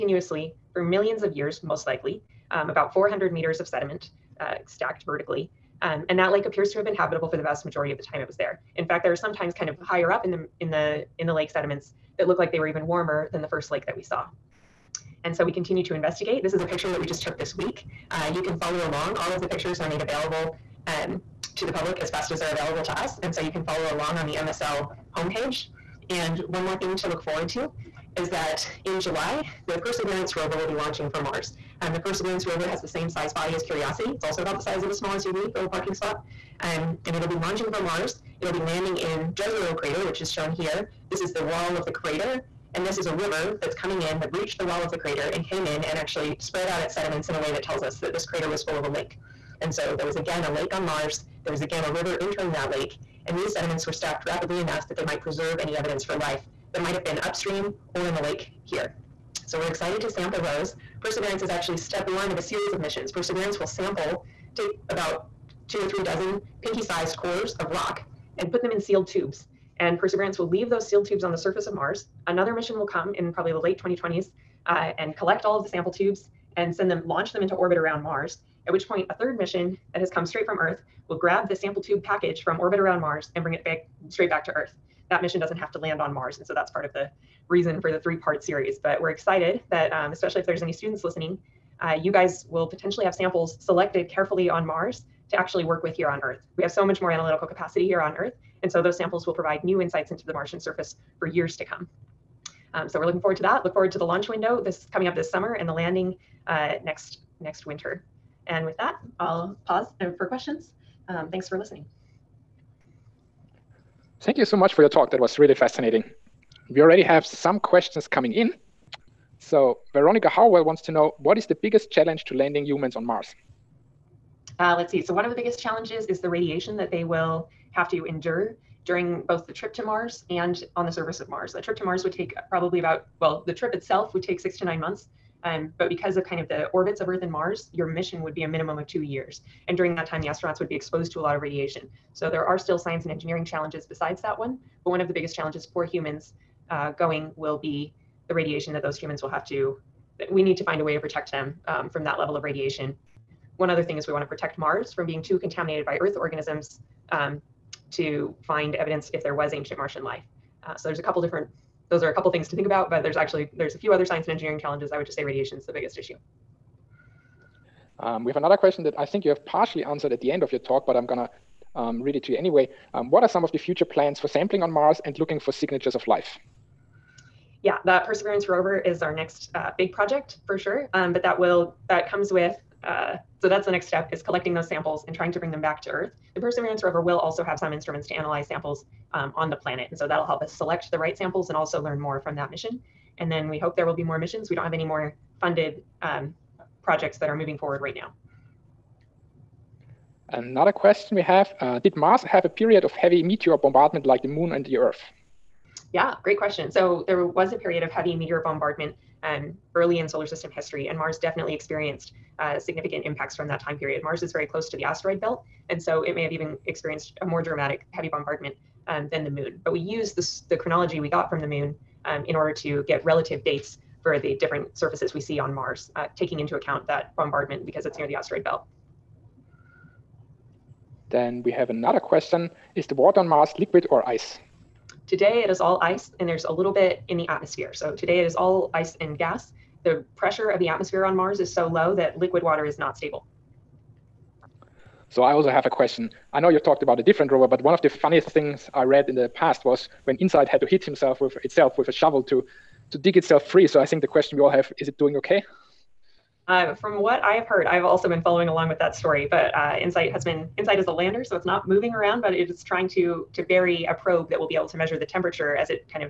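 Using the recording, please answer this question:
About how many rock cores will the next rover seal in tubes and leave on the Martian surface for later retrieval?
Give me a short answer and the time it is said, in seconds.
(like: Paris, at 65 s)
2 or 3 dozen, at 65 s.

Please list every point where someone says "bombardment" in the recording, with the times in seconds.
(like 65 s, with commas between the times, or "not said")
203 s, 208 s, 218 s, 227 s.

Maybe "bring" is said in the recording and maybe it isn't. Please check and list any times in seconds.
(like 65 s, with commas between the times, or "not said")
83 s, 185 s.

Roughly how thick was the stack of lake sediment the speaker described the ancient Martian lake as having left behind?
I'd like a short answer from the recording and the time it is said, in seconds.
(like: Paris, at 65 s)
400 meters, at 2 s.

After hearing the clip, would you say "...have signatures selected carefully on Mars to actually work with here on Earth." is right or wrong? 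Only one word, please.
wrong.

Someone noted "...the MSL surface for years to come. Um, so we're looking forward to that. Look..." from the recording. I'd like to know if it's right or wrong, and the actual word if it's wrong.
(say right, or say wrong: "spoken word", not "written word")
wrong: "Martian", not "MSL".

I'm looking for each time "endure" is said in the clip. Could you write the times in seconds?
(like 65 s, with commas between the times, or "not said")
128 s.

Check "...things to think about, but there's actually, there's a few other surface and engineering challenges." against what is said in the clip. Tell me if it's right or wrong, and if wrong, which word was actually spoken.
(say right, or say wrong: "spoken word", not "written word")
wrong: "science", not "surface".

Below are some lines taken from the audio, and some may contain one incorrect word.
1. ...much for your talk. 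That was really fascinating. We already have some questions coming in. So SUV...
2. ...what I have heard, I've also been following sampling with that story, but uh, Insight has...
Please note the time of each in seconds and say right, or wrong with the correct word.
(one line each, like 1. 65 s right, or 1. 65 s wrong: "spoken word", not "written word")
1. 114 s wrong: "Veronica", not "SUV"
2. 256 s wrong: "along", not "sampling".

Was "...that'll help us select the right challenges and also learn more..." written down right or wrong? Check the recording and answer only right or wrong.
wrong.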